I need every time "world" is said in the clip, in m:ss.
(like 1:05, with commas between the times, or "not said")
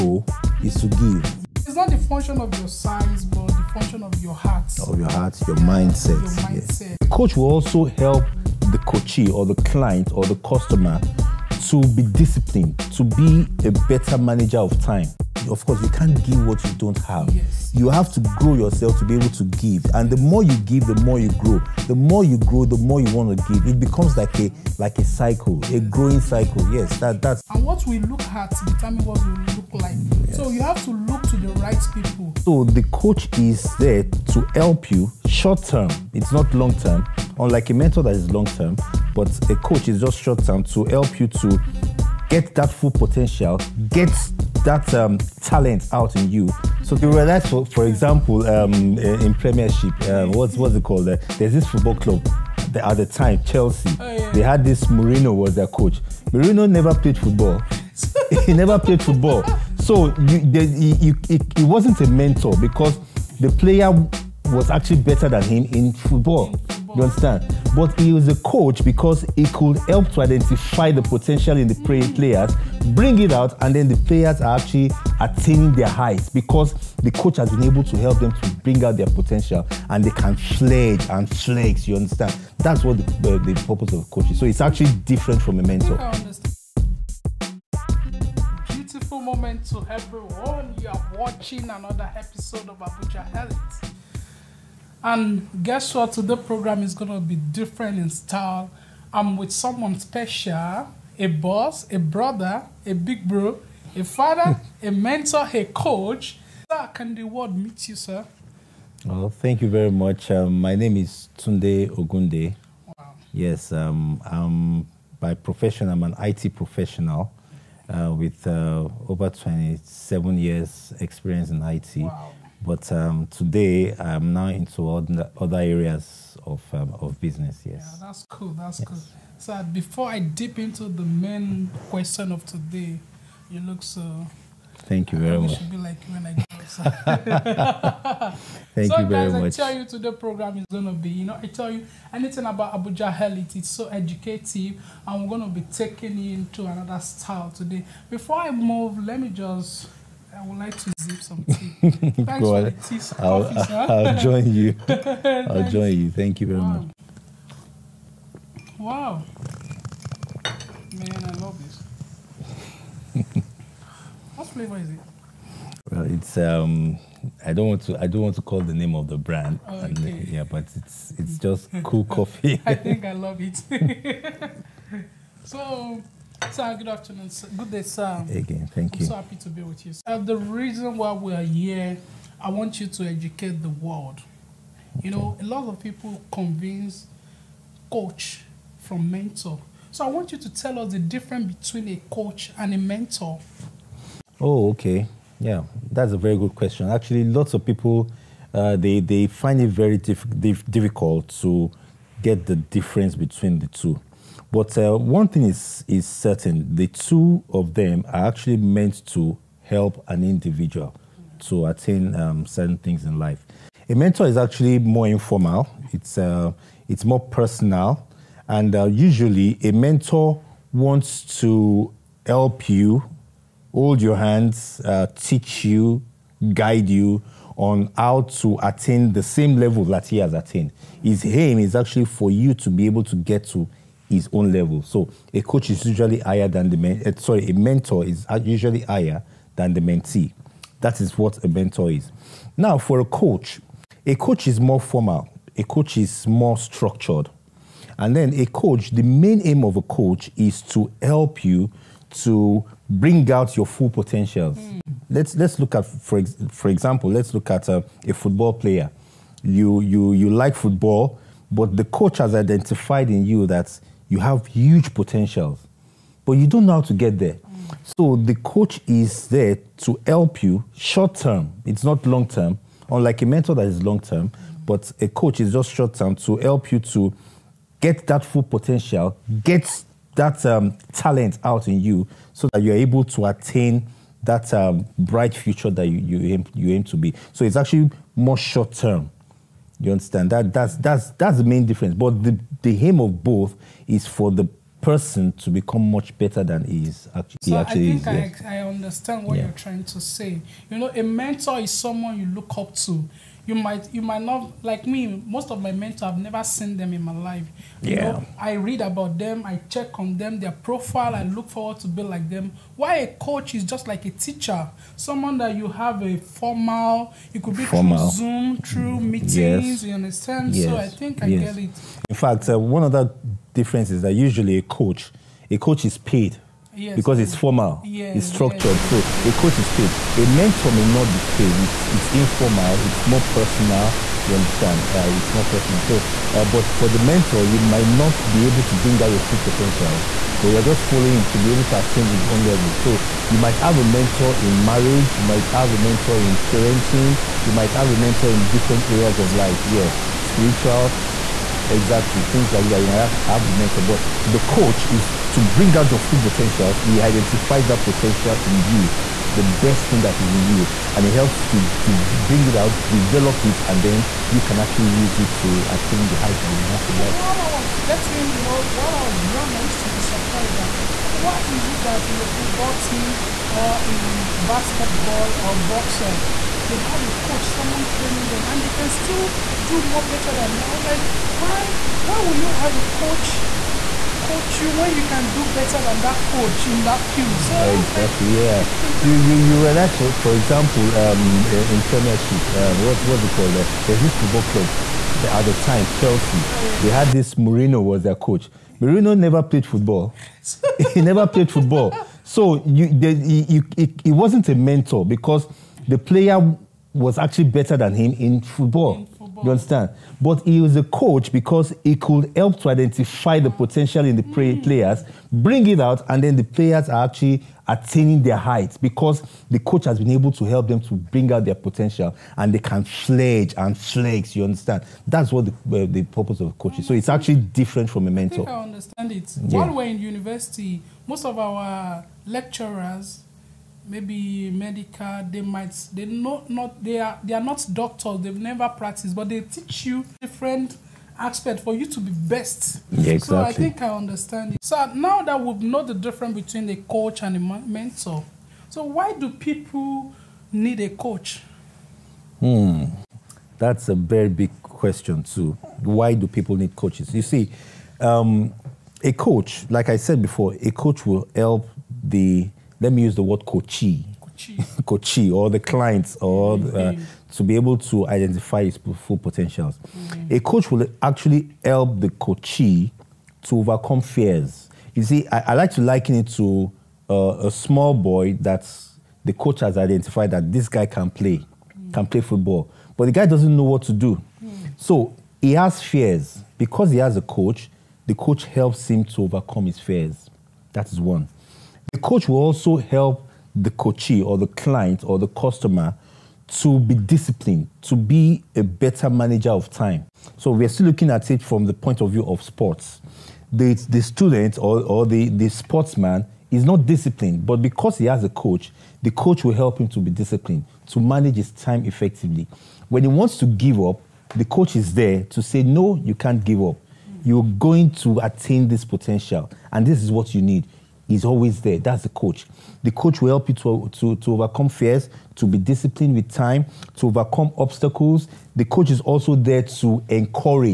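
1:47, 3:03.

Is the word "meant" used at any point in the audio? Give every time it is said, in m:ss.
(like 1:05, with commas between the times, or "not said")
3:28.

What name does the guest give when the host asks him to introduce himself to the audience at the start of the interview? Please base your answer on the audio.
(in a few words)
Tunde Ogunde.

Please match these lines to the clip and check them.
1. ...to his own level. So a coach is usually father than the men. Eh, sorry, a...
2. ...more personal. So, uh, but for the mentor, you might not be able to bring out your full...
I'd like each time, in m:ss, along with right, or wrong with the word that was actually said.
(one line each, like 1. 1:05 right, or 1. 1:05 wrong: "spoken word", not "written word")
1. 3:53 wrong: "higher", not "father"
2. 5:35 right.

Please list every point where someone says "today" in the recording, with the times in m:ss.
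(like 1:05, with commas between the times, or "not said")
1:36, 2:03, 2:12, 2:19, 2:27.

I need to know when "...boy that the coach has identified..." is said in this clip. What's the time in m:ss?
7:57.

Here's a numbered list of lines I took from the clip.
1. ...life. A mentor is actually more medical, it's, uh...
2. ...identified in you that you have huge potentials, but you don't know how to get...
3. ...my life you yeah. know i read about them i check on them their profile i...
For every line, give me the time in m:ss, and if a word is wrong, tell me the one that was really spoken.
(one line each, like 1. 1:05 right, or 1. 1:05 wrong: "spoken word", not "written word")
1. 3:33 wrong: "informal", not "medical"
2. 4:22 right
3. 5:07 right.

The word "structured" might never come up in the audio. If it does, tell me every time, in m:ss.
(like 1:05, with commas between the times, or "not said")
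4:06, 5:28.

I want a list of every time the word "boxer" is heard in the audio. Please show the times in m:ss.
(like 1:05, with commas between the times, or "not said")
6:15.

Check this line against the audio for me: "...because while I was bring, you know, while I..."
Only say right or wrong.
wrong.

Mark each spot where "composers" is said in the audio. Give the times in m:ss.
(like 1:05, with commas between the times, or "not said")
not said.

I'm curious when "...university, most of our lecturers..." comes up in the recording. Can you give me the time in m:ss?
7:10.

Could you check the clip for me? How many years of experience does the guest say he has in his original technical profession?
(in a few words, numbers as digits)
27.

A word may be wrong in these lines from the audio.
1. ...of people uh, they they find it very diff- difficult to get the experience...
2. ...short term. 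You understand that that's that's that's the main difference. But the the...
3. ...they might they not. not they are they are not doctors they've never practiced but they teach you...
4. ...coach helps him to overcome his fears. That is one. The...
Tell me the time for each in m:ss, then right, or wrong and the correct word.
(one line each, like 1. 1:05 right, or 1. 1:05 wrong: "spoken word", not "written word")
1. 3:17 wrong: "difference", not "experience"
2. 4:48 right
3. 7:15 right
4. 8:08 right.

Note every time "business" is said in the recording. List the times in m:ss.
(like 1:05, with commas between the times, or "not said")
2:07, 5:52.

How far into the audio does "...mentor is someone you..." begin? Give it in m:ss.
5:01.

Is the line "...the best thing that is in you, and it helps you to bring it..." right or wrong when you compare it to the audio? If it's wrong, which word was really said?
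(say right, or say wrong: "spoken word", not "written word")
right.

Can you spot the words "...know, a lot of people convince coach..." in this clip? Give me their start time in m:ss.
3:05.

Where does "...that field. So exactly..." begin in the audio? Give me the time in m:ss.
6:26.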